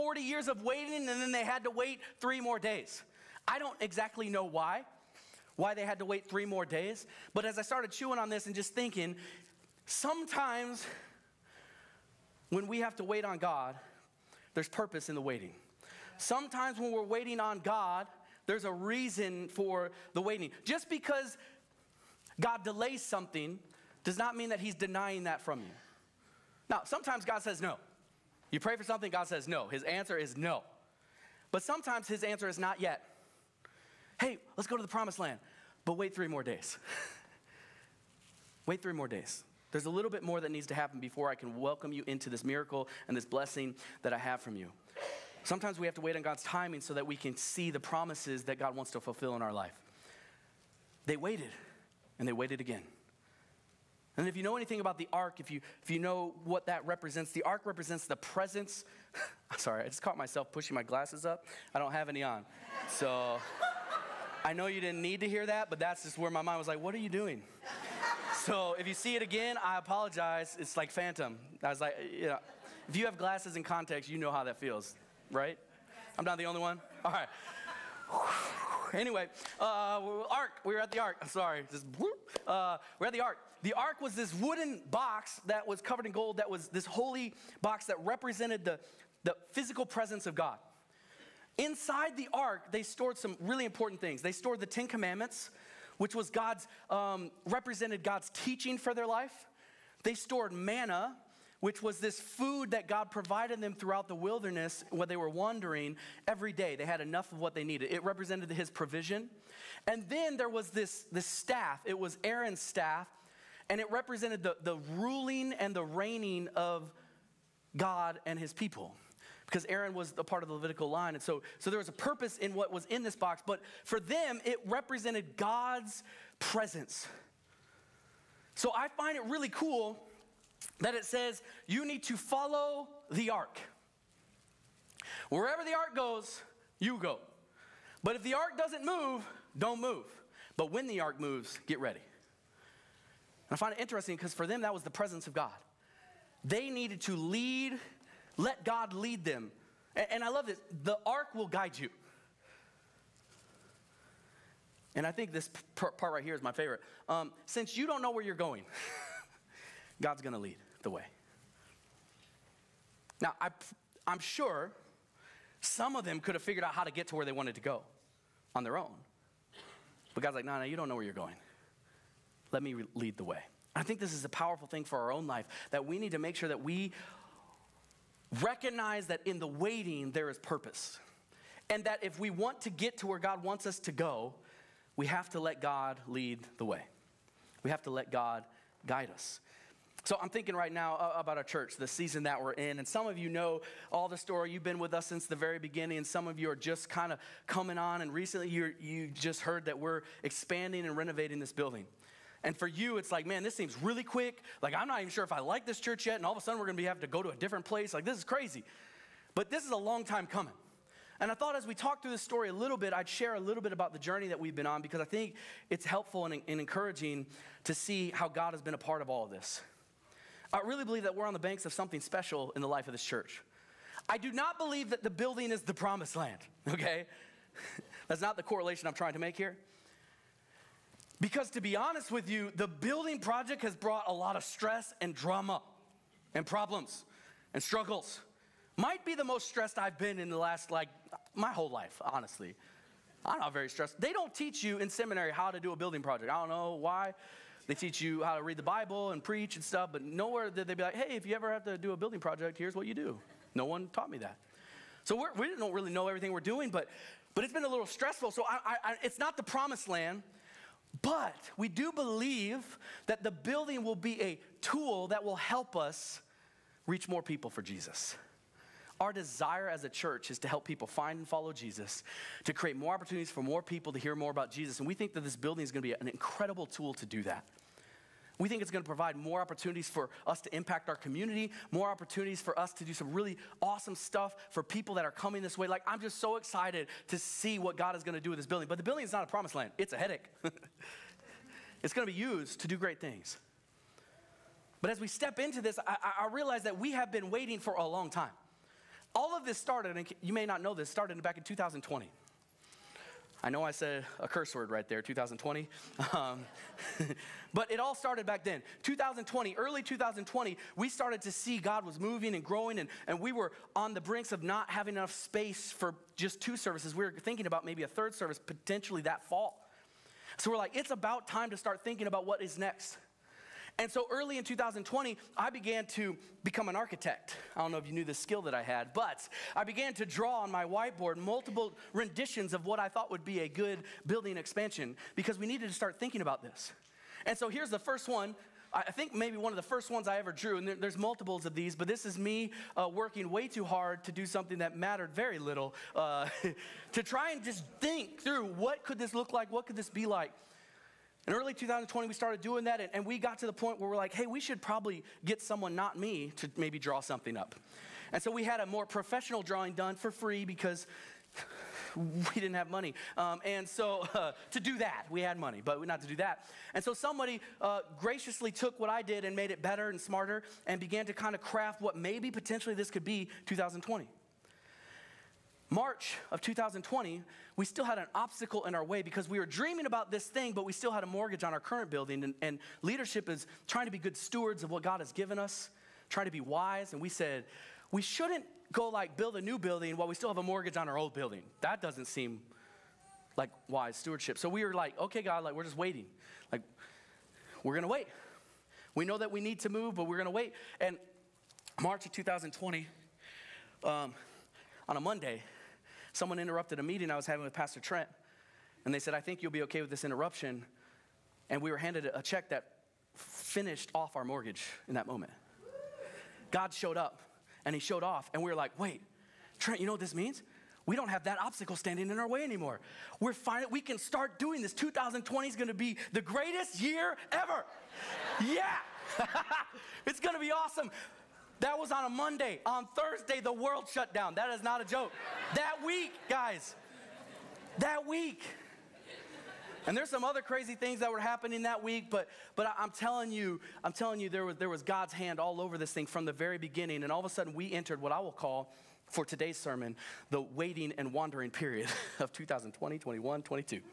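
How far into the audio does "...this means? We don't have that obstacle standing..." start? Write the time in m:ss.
6:59.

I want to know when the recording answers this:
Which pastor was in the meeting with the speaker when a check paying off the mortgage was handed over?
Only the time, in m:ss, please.
6:47.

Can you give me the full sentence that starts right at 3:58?
Might be the most stressed I've been in the last, like, my whole life, honestly.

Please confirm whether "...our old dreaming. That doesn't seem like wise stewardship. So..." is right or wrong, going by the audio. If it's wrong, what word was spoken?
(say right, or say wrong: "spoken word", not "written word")
wrong: "building", not "dreaming".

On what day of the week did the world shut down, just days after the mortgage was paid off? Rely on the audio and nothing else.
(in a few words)
Thursday.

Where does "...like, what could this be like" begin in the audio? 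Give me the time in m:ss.
5:49.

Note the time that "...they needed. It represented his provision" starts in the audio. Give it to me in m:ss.
1:47.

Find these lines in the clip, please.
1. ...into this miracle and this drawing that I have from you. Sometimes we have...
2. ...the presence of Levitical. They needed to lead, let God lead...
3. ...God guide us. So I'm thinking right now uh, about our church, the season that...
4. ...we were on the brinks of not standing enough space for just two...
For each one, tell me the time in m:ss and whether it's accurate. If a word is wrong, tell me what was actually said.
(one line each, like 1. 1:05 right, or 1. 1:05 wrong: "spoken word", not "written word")
1. 0:42 wrong: "blessing", not "drawing"
2. 2:24 wrong: "God", not "Levitical"
3. 3:08 right
4. 5:13 wrong: "having", not "standing".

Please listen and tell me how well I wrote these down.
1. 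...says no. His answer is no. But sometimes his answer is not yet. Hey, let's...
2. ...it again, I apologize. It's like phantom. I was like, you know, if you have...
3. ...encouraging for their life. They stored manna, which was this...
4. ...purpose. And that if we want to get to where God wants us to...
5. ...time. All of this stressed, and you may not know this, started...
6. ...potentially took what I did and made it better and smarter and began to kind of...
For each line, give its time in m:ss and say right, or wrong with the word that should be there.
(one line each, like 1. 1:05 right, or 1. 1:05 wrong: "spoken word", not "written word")
1. 0:29 right
2. 1:09 right
3. 1:38 wrong: "teaching", not "encouraging"
4. 3:00 right
5. 4:58 wrong: "started", not "stressed"
6. 6:07 wrong: "graciously", not "potentially".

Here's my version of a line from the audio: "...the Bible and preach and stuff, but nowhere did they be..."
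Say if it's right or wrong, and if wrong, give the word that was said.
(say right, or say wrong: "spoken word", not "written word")
right.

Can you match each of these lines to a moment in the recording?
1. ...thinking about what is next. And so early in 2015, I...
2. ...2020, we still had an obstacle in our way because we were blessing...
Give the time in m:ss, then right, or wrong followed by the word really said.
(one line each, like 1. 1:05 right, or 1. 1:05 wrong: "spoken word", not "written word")
1. 5:21 wrong: "2020", not "2015"
2. 6:16 wrong: "dreaming", not "blessing".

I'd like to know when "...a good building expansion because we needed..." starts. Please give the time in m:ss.
5:33.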